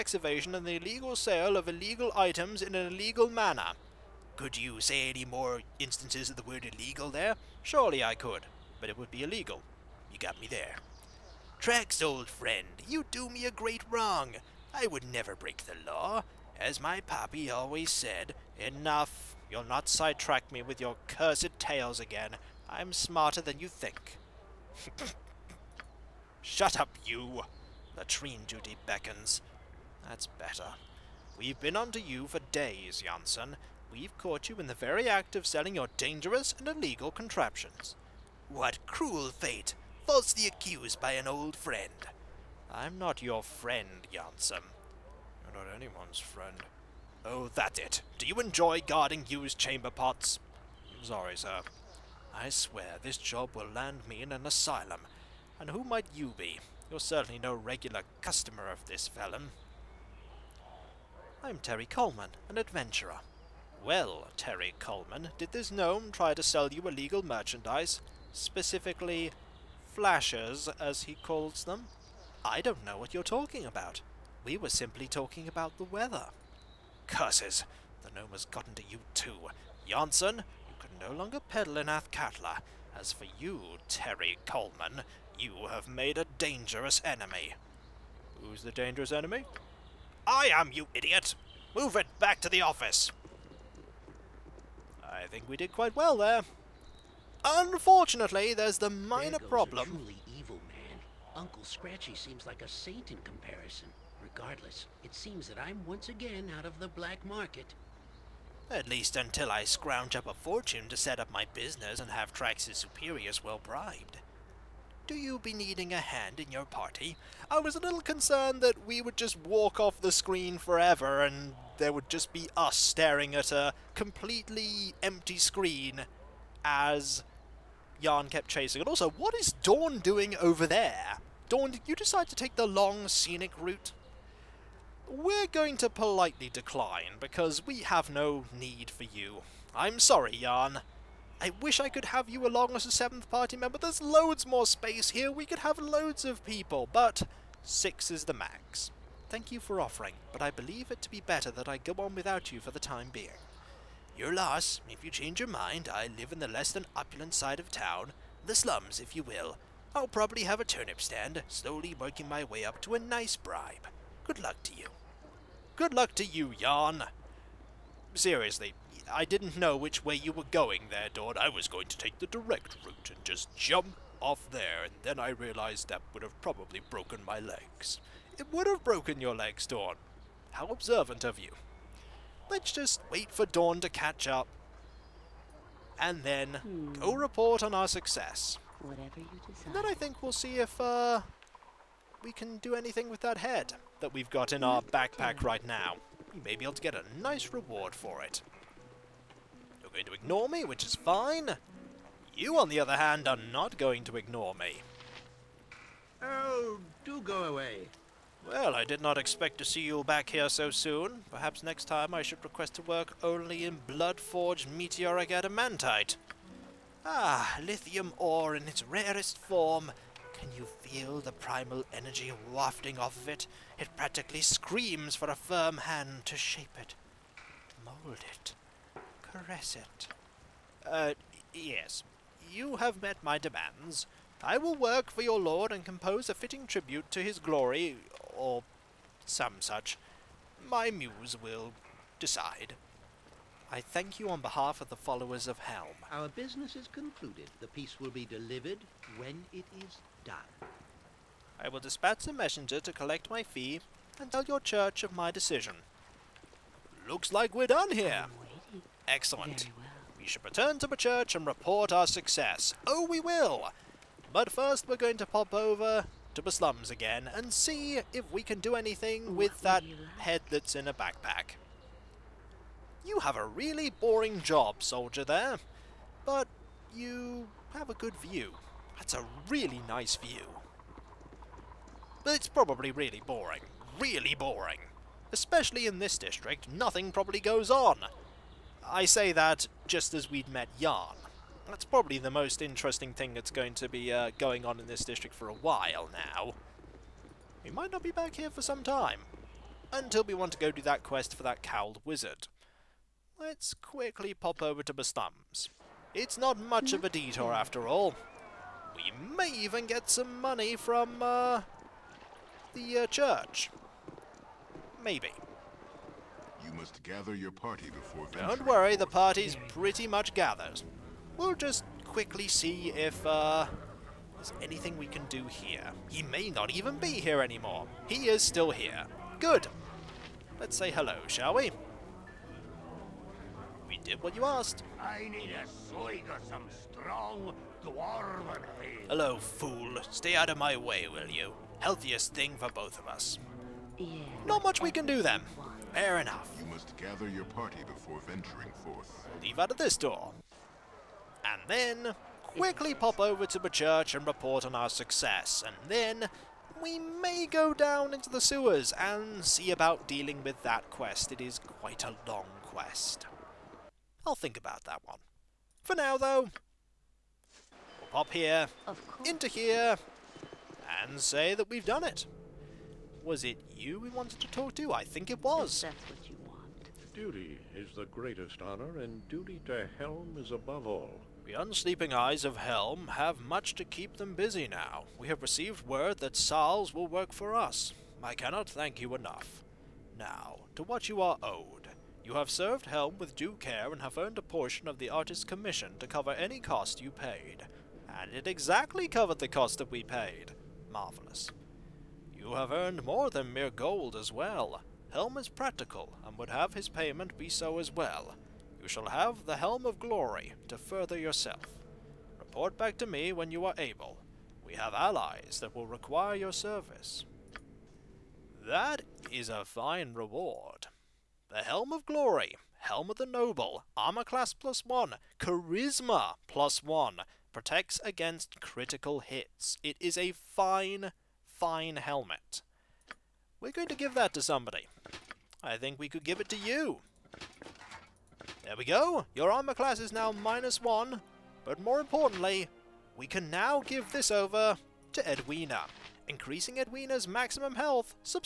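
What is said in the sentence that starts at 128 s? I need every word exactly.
And also, what is Dorn doing over there?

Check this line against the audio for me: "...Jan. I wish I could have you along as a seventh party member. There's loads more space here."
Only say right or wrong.
right.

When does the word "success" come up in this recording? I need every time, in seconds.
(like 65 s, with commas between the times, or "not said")
187 s, 262 s, 354 s.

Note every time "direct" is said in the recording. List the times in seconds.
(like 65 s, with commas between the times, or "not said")
172 s.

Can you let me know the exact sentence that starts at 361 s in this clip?
It is quite a long quest.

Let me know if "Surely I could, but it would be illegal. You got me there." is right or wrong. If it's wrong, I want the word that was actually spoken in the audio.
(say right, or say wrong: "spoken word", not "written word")
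right.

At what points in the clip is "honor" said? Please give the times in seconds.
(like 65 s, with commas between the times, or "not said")
378 s.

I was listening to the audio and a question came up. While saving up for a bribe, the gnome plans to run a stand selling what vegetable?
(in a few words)
turnip.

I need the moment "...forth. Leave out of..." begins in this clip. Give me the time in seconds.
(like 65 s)
348 s.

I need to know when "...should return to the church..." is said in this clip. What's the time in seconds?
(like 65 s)
260 s.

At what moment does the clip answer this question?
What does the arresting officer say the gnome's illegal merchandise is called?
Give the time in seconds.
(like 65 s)
69 s.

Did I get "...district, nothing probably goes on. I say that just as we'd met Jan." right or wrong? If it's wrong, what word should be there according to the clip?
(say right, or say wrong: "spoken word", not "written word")
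right.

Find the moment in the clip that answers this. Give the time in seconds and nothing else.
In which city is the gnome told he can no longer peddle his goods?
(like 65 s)
81 s.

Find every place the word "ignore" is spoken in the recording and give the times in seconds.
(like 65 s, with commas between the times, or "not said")
200 s, 204 s.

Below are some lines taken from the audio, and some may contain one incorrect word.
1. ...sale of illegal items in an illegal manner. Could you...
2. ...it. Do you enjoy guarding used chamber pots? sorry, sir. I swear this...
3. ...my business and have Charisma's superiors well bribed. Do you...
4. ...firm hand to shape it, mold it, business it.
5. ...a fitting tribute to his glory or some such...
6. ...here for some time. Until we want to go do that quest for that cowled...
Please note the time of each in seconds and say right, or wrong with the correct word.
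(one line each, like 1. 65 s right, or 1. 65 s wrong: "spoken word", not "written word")
1. 1 s right
2. 47 s right
3. 111 s wrong: "Trax", not "Charisma"
4. 225 s wrong: "caress", not "business"
5. 236 s right
6. 298 s right.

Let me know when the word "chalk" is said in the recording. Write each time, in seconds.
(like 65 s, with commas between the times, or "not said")
not said.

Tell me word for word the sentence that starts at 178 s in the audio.
It would have broken your legs, Dorn.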